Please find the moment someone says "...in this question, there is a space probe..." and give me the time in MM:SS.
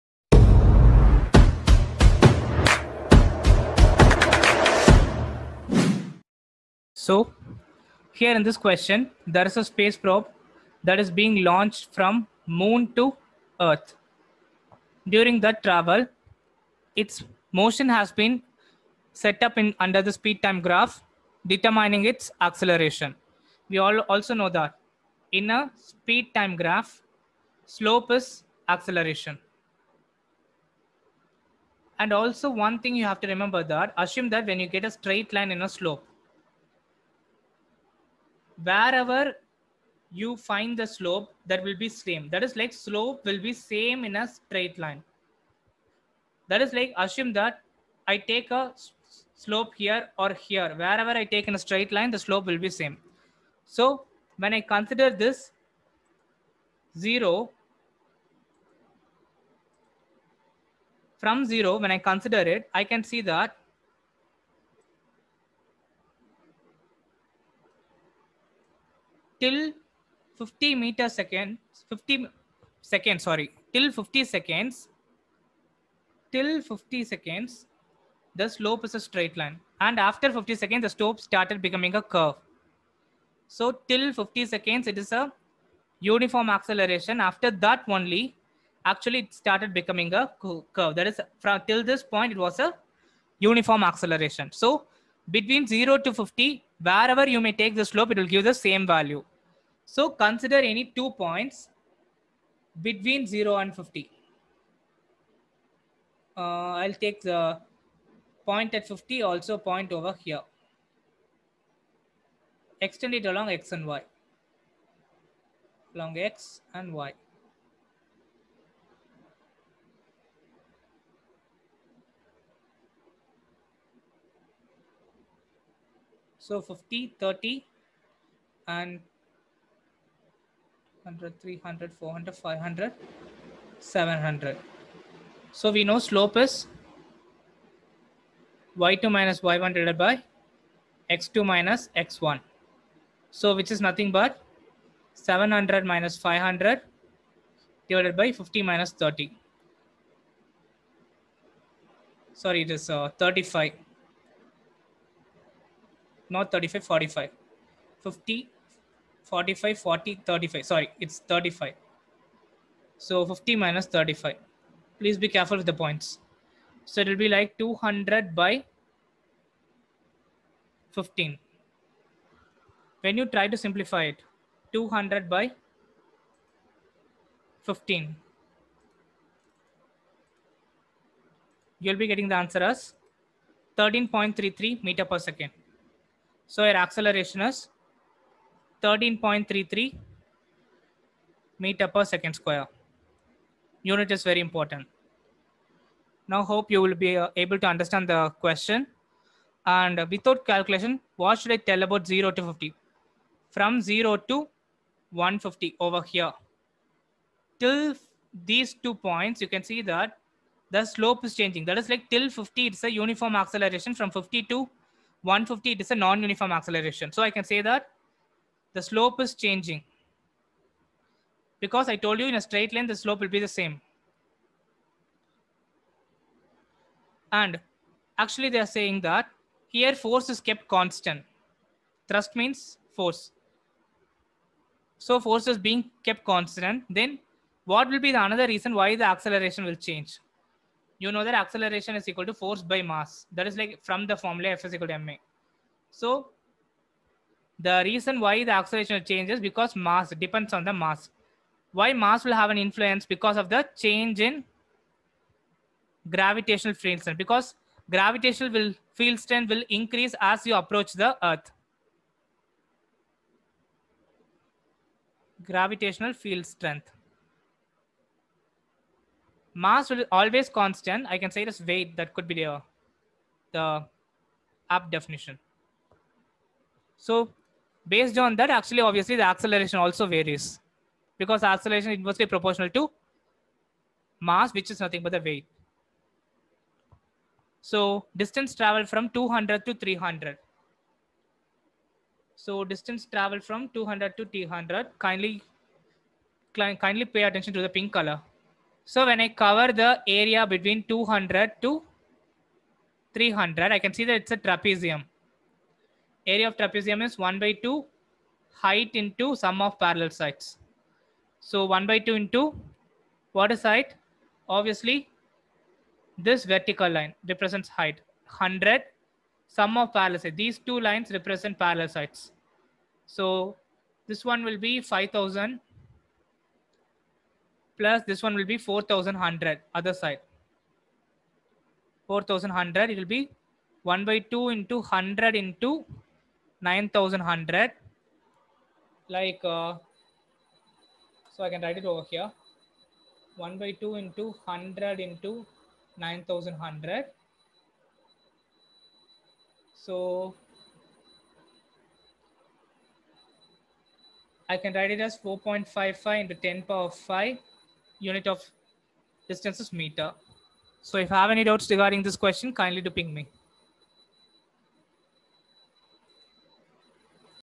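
00:08.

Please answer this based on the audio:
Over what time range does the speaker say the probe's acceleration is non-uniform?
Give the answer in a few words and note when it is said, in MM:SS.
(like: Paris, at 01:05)
50 to 150, at 03:33.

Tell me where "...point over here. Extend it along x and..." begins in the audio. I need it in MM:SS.
01:49.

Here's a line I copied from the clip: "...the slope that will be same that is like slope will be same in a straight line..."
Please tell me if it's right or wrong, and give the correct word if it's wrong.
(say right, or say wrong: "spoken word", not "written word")
right.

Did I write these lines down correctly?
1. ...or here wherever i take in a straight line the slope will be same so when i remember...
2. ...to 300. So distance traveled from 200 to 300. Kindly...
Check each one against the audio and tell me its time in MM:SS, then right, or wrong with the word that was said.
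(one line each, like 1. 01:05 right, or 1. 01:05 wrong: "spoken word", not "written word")
1. 00:50 wrong: "consider", not "remember"
2. 04:49 right.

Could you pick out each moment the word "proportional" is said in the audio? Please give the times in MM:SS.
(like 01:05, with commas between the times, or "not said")
04:42.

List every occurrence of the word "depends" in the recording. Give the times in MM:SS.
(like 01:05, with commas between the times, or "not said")
04:10.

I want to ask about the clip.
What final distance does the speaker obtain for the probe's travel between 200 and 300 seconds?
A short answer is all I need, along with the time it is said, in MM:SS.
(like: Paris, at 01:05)
4.55 × 10^5 m, at 05:55.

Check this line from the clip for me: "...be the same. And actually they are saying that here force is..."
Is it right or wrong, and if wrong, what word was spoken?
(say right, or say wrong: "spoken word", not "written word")
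right.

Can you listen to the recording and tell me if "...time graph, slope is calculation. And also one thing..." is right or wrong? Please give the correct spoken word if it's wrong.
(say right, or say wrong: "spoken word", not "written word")
wrong: "acceleration", not "calculation".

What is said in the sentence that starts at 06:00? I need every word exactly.
So if you have any doubts regarding this question, kindly do ping me.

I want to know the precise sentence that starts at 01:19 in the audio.
And after 50 seconds, the slope started becoming a curve.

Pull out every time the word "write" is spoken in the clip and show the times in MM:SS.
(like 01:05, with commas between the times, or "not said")
05:41, 05:54.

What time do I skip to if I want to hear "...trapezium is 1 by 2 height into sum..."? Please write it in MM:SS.
05:06.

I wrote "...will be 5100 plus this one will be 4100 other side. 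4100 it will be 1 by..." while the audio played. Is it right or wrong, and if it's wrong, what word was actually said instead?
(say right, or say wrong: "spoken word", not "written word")
wrong: "5000", not "5100".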